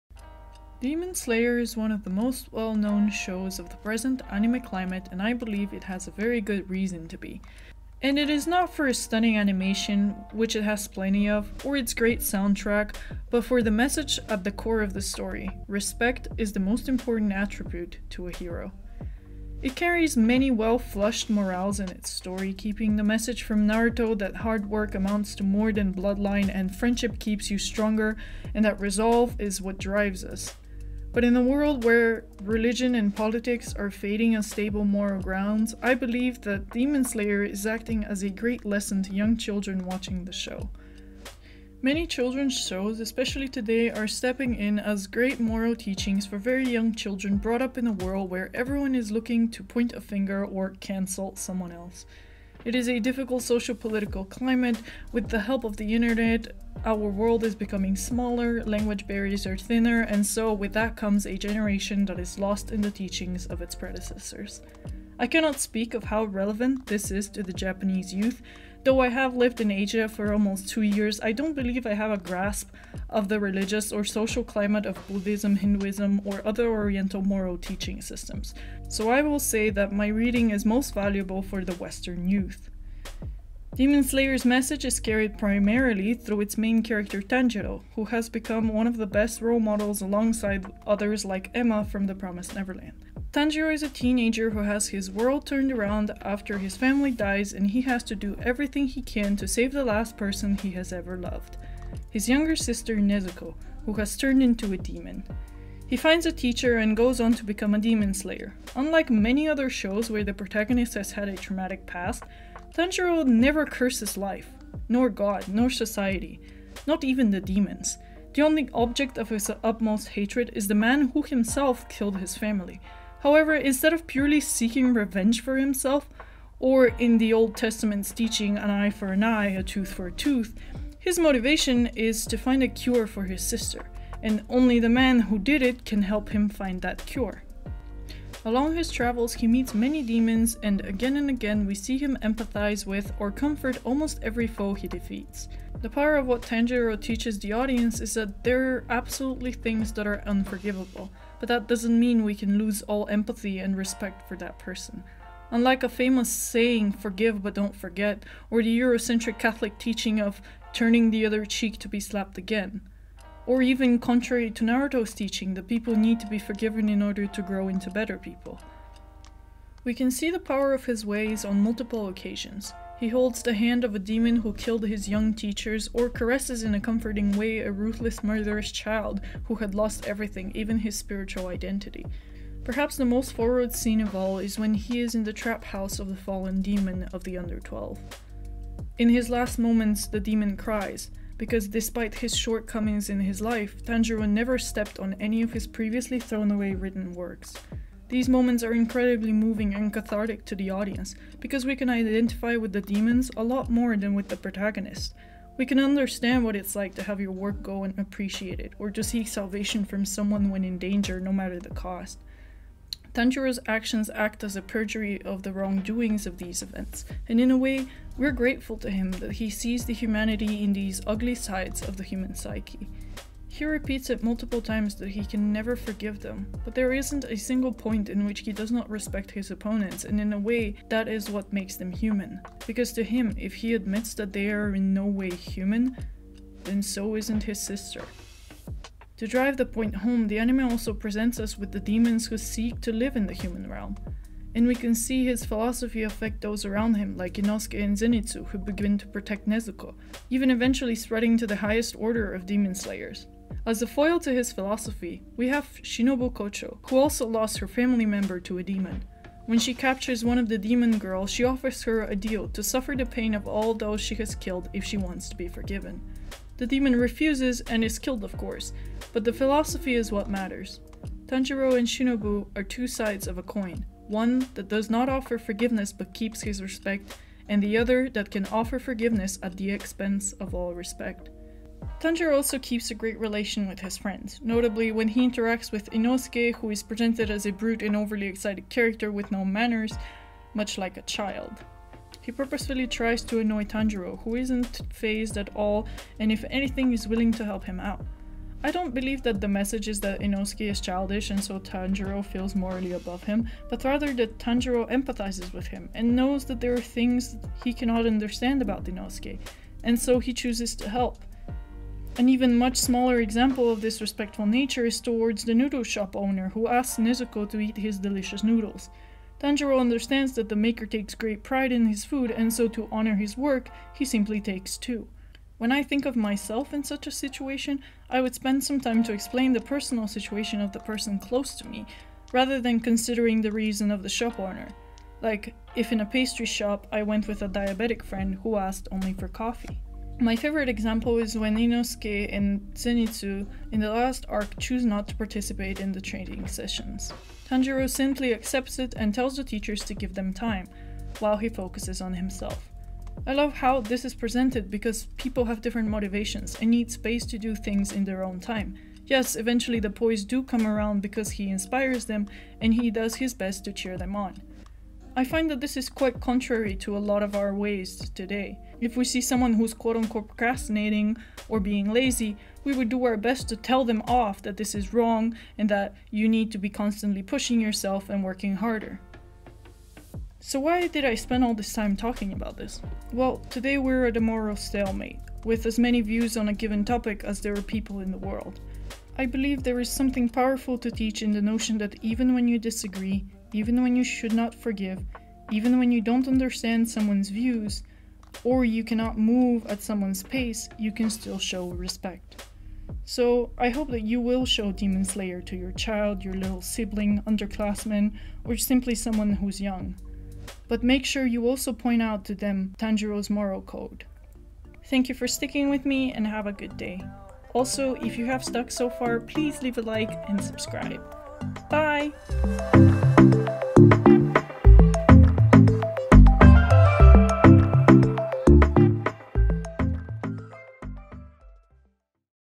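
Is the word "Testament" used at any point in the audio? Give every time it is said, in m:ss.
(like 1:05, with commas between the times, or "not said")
2:07.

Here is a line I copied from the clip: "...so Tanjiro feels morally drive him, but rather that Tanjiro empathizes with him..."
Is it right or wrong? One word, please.
wrong.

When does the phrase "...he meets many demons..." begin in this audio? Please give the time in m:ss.
2:19.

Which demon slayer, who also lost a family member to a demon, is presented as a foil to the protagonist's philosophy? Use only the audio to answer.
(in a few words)
Shinobu Kocho.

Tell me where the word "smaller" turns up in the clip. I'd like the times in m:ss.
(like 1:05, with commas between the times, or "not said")
0:57, 5:12.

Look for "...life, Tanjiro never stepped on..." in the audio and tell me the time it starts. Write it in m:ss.
3:13.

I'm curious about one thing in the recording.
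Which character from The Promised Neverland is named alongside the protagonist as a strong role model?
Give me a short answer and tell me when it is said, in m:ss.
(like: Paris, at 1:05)
Emma, at 1:31.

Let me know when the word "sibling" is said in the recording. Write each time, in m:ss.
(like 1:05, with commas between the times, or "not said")
6:46.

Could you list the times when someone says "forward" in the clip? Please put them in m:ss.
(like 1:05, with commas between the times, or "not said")
3:03.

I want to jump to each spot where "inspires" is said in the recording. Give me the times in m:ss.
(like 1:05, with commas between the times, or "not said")
6:01.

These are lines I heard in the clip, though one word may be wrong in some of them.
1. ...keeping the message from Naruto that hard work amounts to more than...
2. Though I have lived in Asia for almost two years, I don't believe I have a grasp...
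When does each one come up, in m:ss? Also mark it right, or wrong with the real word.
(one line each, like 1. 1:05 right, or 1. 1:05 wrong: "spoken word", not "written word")
1. 0:22 right
2. 1:08 right.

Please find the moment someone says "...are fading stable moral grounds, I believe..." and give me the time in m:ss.
0:33.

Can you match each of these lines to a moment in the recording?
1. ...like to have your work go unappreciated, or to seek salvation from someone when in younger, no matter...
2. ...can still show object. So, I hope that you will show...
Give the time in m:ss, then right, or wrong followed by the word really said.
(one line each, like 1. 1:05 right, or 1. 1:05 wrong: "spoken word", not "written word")
1. 3:26 wrong: "danger", not "younger"
2. 6:40 wrong: "respect", not "object".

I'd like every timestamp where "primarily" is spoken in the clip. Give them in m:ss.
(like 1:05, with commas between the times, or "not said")
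1:25.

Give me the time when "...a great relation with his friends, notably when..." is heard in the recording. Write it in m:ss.
4:42.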